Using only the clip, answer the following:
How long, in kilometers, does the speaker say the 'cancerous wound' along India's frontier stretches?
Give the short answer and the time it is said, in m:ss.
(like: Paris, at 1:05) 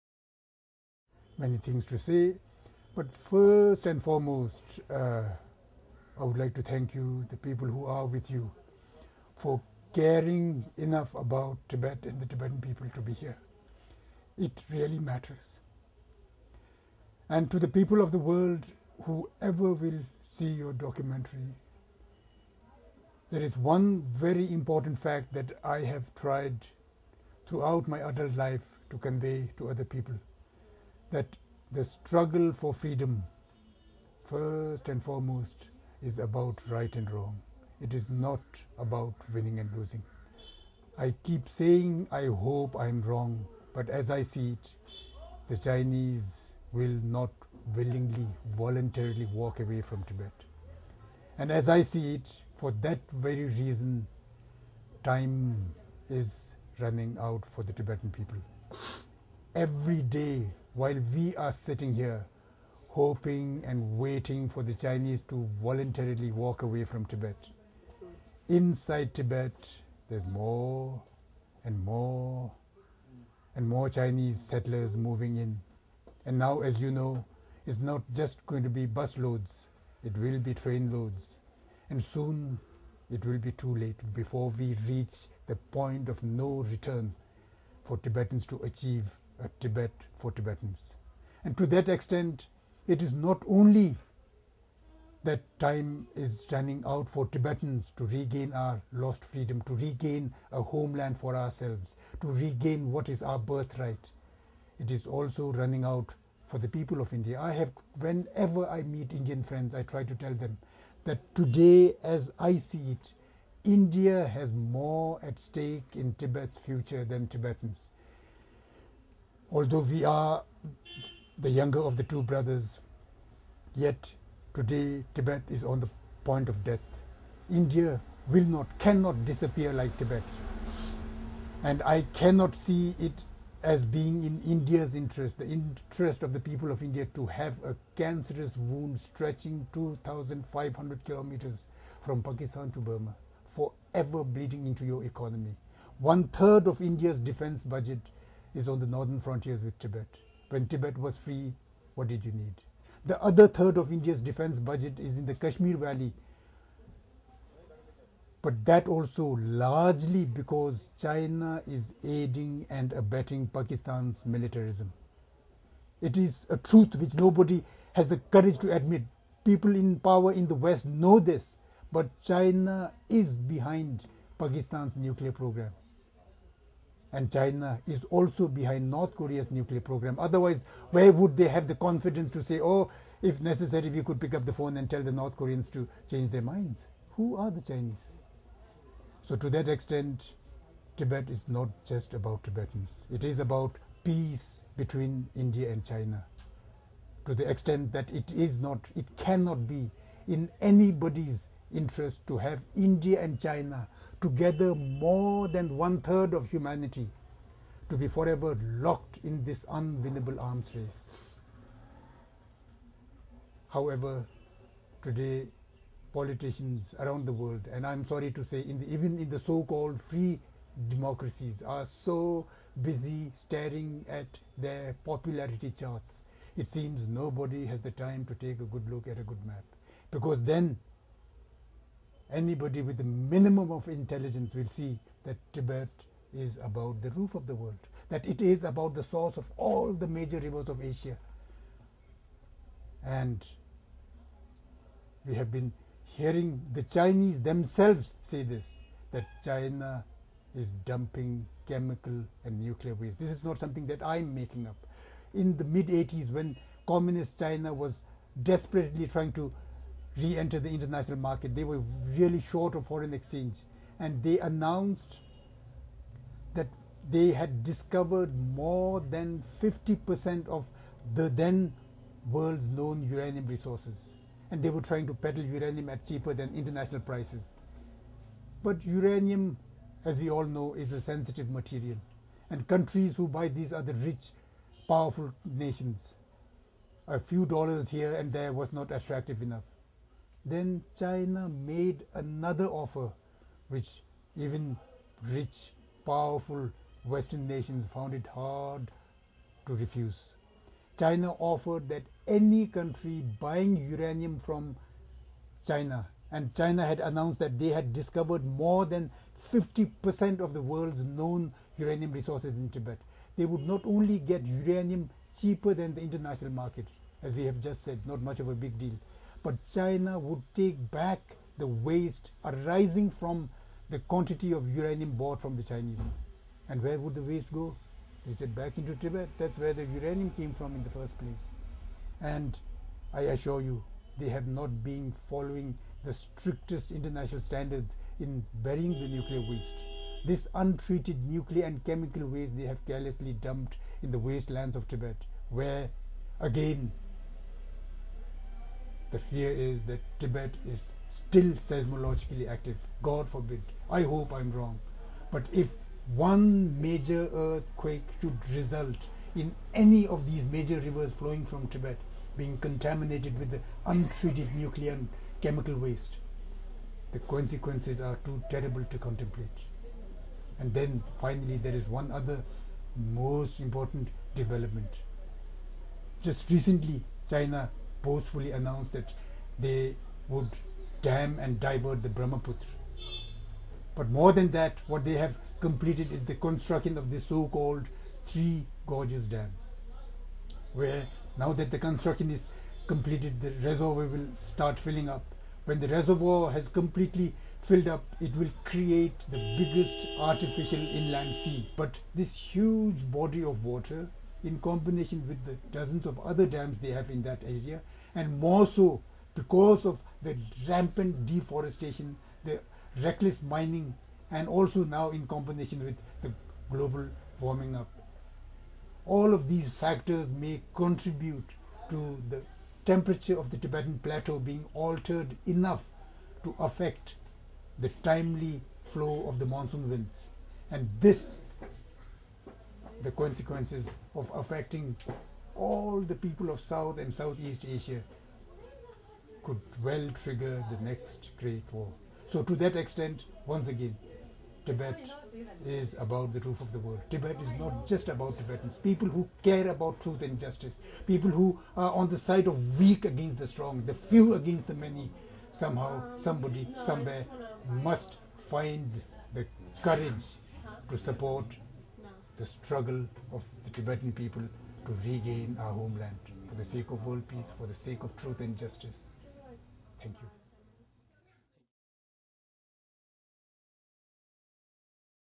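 2,500 kilometers, at 2:19.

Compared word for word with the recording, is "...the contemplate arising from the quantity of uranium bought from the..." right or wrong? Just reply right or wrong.
wrong.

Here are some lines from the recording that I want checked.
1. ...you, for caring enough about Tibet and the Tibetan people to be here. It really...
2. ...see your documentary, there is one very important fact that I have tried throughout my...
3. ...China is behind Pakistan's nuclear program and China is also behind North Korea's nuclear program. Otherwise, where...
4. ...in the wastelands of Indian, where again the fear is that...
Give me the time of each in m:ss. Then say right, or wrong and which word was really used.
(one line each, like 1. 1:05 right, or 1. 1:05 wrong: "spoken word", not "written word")
1. 0:08 right
2. 0:20 right
3. 2:52 right
4. 5:44 wrong: "Tibet", not "Indian".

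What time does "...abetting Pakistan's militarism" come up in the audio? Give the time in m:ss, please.
2:42.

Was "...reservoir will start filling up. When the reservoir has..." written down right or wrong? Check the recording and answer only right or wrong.
right.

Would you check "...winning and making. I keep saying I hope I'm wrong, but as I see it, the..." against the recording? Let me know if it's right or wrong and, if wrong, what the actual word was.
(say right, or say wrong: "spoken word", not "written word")
wrong: "losing", not "making".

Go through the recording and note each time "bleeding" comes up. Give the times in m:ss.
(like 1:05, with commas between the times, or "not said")
2:24.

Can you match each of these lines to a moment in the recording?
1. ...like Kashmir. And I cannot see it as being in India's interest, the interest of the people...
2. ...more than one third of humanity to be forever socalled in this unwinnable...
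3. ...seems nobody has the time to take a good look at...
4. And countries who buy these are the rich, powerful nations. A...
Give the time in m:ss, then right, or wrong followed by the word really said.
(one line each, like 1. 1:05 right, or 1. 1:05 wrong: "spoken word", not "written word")
1. 2:09 wrong: "Tibet", not "Kashmir"
2. 3:24 wrong: "locked", not "socalled"
3. 3:46 right
4. 4:42 right.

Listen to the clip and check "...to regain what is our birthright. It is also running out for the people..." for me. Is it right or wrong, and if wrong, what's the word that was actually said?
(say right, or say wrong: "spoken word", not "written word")
right.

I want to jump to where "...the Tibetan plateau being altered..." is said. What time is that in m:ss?
7:03.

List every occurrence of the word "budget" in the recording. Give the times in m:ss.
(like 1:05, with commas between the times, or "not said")
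2:27, 2:34.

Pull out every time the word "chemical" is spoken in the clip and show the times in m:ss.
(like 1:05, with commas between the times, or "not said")
4:11, 5:41, 6:05.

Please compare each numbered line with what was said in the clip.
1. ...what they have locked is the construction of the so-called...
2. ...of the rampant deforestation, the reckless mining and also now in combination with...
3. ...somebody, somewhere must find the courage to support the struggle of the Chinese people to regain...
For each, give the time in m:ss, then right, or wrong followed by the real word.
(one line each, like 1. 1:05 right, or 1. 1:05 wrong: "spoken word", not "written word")
1. 6:24 wrong: "completed", not "locked"
2. 6:49 right
3. 7:36 wrong: "Tibetan", not "Chinese".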